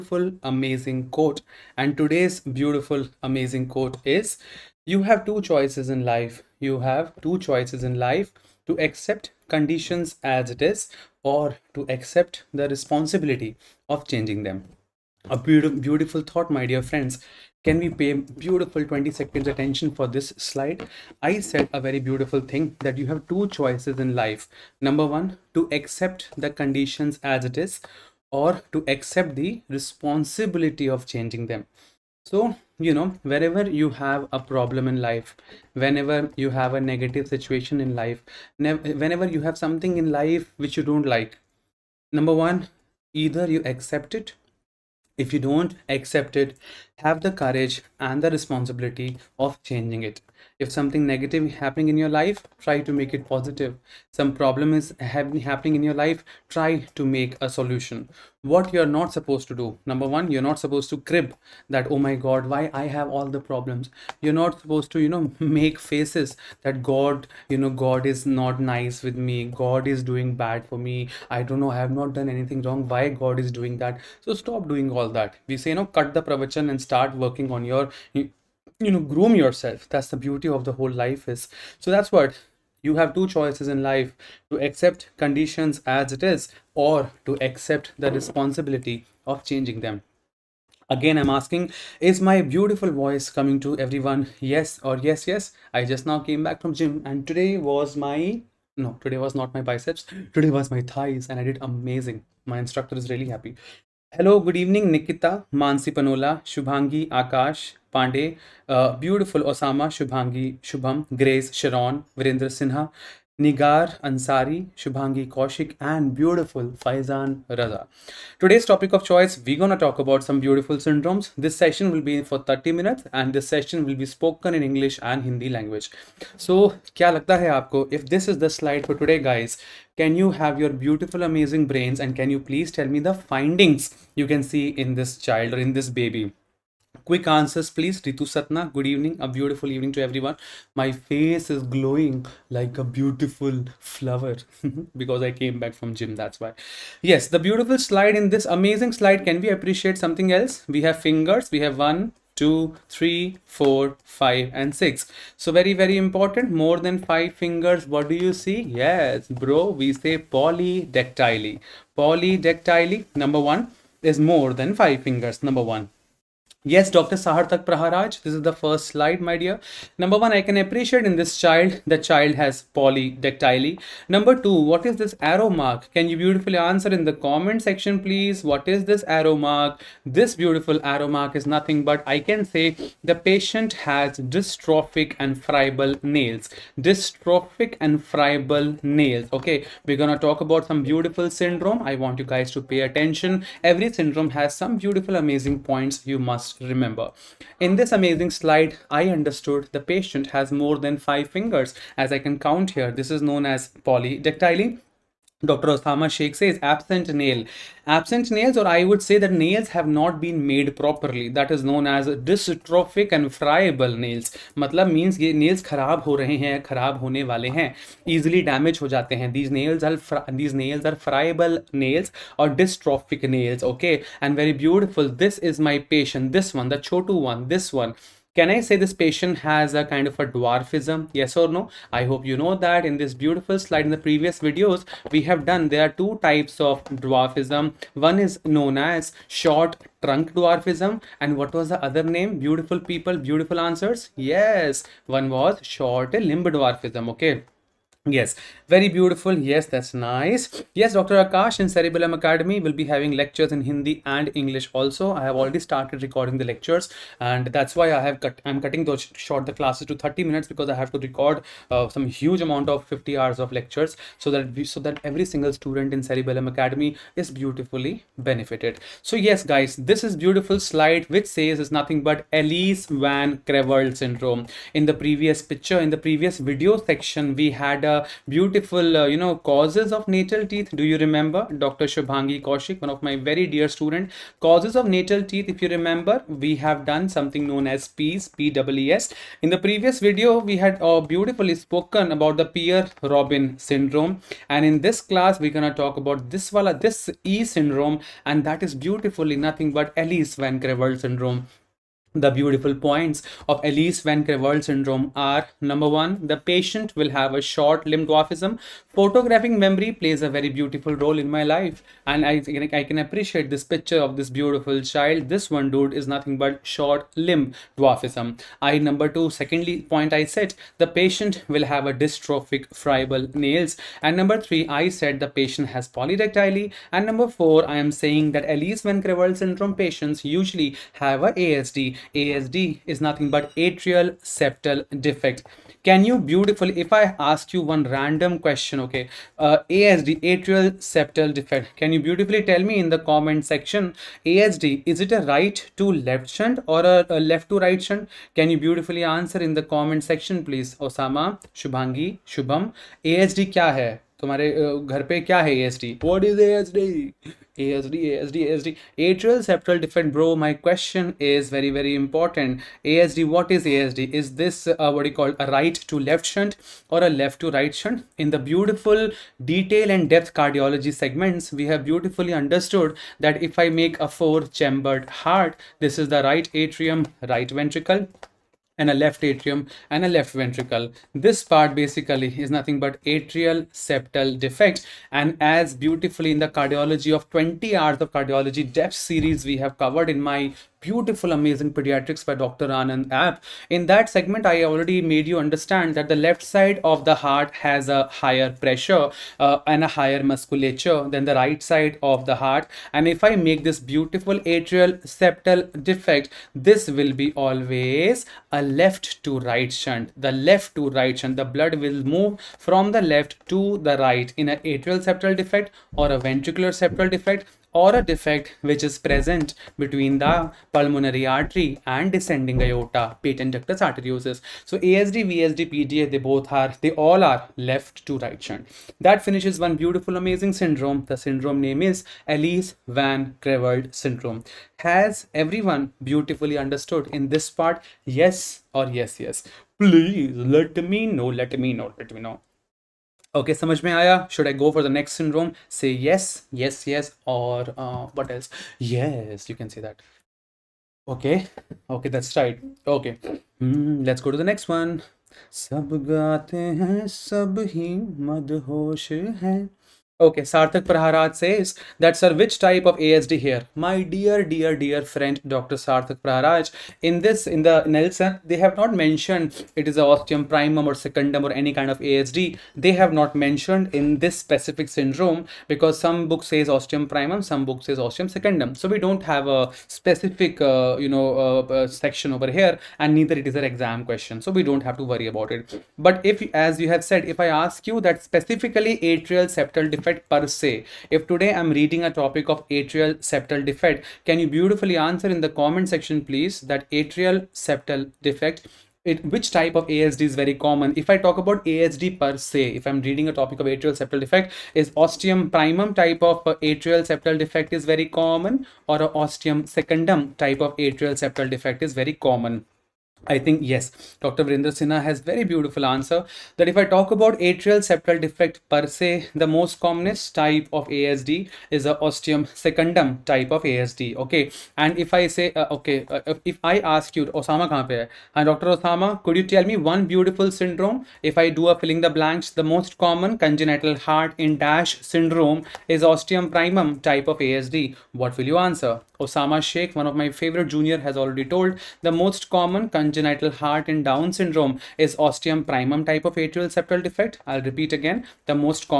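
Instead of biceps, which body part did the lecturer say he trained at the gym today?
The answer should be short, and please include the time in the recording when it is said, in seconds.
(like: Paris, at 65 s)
Thighs, at 100 s.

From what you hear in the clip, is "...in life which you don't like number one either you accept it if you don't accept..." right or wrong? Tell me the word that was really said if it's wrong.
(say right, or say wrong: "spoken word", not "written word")
right.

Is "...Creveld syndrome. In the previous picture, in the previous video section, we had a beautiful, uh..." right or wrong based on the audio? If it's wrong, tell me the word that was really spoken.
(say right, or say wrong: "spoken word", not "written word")
right.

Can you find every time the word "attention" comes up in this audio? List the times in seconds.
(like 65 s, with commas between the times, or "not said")
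19 s, 192 s.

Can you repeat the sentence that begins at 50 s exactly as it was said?
If something negative is happening in your life, try to make it positive.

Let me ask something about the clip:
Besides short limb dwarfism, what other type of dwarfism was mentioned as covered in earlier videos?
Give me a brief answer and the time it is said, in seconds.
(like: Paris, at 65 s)
Short trunk dwarfism, at 239 s.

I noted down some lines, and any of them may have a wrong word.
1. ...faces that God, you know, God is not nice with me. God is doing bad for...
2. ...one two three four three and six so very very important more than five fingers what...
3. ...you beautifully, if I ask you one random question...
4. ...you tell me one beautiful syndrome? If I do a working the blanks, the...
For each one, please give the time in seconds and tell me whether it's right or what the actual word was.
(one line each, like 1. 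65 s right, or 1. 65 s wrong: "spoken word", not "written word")
1. 65 s right
2. 151 s wrong: "five", not "three"
3. 336 s right
4. 529 s wrong: "filling", not "working".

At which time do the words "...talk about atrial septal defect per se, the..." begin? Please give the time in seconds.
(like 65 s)
516 s.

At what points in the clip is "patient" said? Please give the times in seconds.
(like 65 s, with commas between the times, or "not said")
183 s, 199 s, 228 s, 306 s, 320 s, 325 s, 329 s.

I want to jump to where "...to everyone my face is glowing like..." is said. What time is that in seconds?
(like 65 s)
139 s.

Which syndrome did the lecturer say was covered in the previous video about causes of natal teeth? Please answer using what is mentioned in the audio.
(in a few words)
Pierre-Robin syndrome.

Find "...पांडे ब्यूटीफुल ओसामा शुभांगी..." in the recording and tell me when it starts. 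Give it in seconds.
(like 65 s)
107 s.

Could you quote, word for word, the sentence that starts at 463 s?
My dear, dear, dear friend, Dr.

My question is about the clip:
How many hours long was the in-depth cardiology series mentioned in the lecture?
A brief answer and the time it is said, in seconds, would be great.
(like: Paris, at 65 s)
20 hours, at 387 s.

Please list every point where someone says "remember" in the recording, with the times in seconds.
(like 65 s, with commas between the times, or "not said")
196 s, 281 s, 285 s.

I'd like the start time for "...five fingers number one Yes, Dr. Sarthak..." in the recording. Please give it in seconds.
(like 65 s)
164 s.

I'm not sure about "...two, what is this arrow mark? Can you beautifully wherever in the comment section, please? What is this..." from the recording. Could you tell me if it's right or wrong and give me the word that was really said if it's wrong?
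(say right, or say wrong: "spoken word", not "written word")
wrong: "answer", not "wherever".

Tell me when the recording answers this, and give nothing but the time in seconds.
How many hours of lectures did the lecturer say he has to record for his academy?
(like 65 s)
262 s.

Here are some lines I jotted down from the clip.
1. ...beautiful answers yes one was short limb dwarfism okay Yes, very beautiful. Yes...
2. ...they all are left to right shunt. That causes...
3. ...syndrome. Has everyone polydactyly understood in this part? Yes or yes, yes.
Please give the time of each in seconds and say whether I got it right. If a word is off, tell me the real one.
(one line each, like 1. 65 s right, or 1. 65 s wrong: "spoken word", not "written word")
1. 243 s right
2. 426 s wrong: "finishes", not "causes"
3. 433 s wrong: "beautifully", not "polydactyly".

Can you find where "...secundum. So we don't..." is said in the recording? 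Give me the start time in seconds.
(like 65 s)
478 s.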